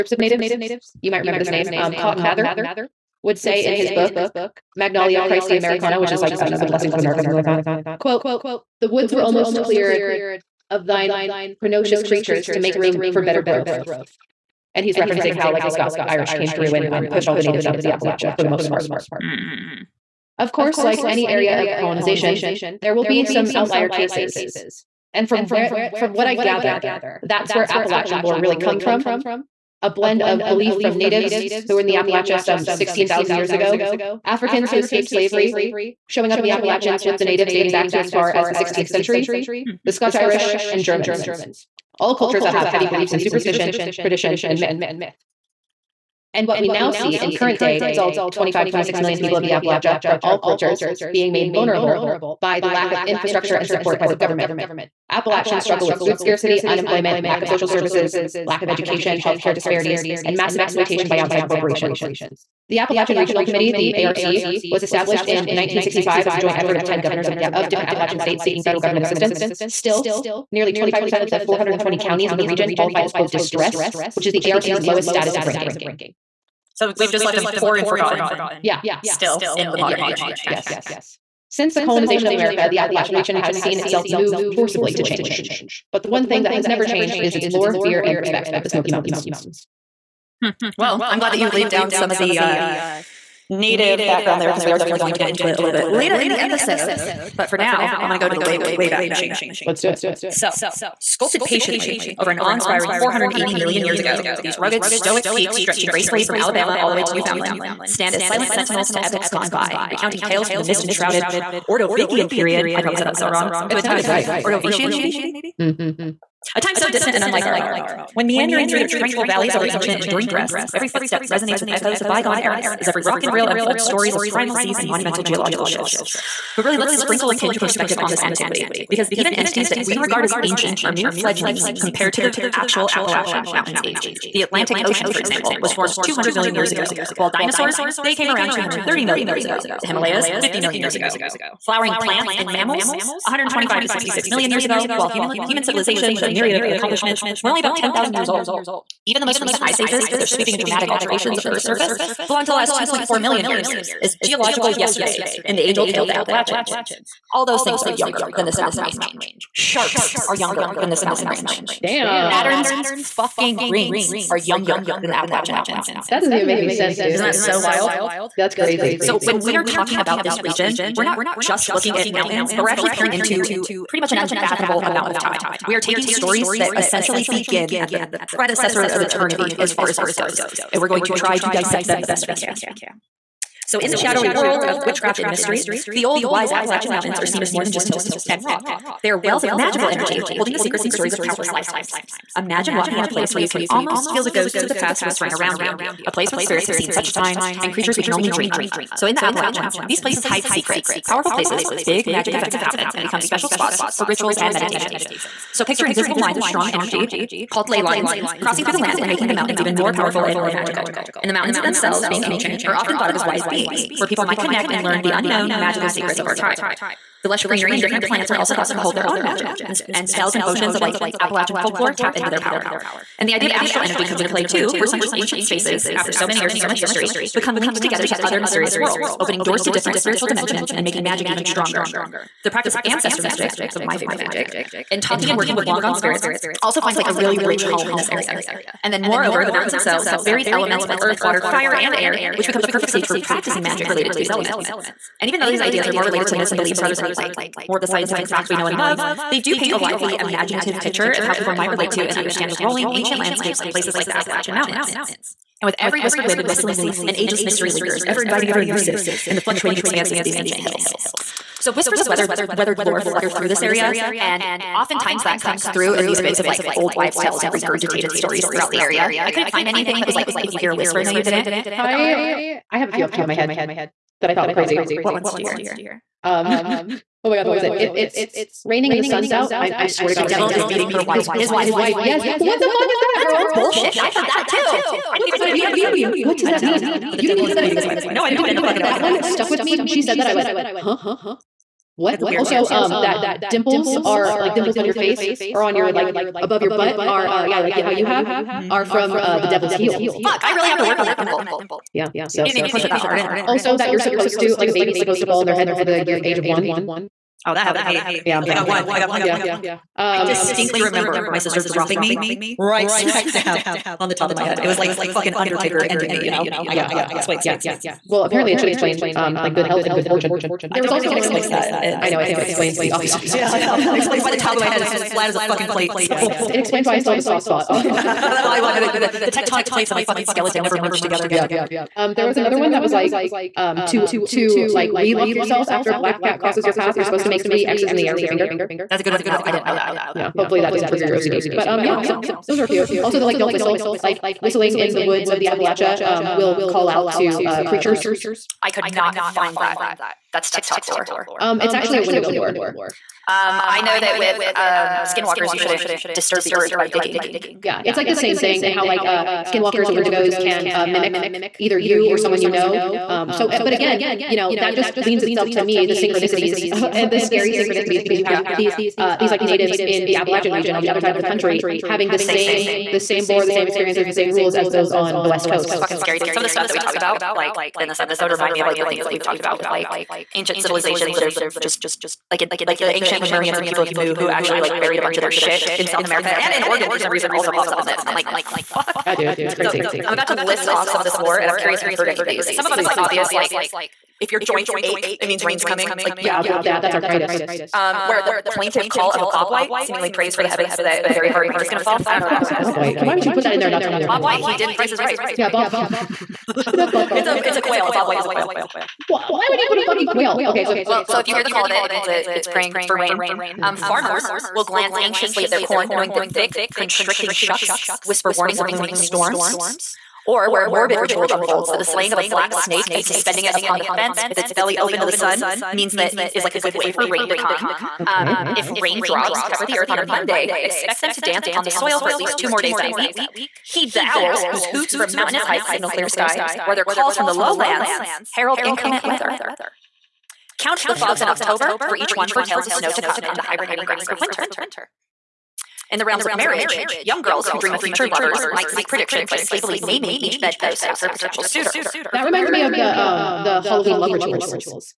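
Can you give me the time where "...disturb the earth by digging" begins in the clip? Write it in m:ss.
5:56.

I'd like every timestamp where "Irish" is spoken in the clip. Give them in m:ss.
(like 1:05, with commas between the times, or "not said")
0:16, 0:40.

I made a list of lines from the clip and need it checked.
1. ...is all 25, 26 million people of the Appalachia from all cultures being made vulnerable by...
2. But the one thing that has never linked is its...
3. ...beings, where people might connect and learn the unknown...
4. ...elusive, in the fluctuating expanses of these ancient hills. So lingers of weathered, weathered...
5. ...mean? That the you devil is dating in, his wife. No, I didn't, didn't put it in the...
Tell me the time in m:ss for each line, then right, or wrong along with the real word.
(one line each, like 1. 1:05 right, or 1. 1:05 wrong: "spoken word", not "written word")
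1. 0:47 right
2. 1:25 wrong: "changed", not "linked"
3. 3:33 right
4. 4:18 wrong: "whispers", not "lingers"
5. 4:46 wrong: "beating", not "dating".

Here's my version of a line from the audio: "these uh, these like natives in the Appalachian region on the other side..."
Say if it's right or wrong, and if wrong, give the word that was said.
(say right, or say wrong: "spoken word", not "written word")
right.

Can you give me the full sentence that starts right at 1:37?
But for now, I'm going to go to the way, way, way back machine.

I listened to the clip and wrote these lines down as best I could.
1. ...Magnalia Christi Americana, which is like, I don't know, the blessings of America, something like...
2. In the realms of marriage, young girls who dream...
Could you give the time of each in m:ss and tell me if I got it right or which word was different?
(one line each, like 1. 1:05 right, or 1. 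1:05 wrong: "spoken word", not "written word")
1. 0:04 right
2. 7:25 right.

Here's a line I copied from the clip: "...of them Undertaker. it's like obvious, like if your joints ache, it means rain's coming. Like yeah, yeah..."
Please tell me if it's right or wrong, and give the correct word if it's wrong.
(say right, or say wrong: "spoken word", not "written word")
wrong: "Please", not "Undertaker".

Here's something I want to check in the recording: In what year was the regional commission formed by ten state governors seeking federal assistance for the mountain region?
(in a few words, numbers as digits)
1965.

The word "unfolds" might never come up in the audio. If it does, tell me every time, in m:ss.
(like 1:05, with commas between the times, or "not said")
2:03, 7:01.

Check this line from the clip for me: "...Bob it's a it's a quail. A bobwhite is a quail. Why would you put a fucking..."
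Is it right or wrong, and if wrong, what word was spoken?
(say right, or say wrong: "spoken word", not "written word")
right.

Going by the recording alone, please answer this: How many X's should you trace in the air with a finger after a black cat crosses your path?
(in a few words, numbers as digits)
3.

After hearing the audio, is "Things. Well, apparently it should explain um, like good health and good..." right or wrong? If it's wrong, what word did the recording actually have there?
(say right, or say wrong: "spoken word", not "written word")
right.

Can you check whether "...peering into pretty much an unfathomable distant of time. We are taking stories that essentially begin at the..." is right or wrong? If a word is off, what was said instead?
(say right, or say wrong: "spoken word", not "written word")
wrong: "amount", not "distant".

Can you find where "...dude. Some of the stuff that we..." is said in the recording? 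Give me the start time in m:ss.
6:16.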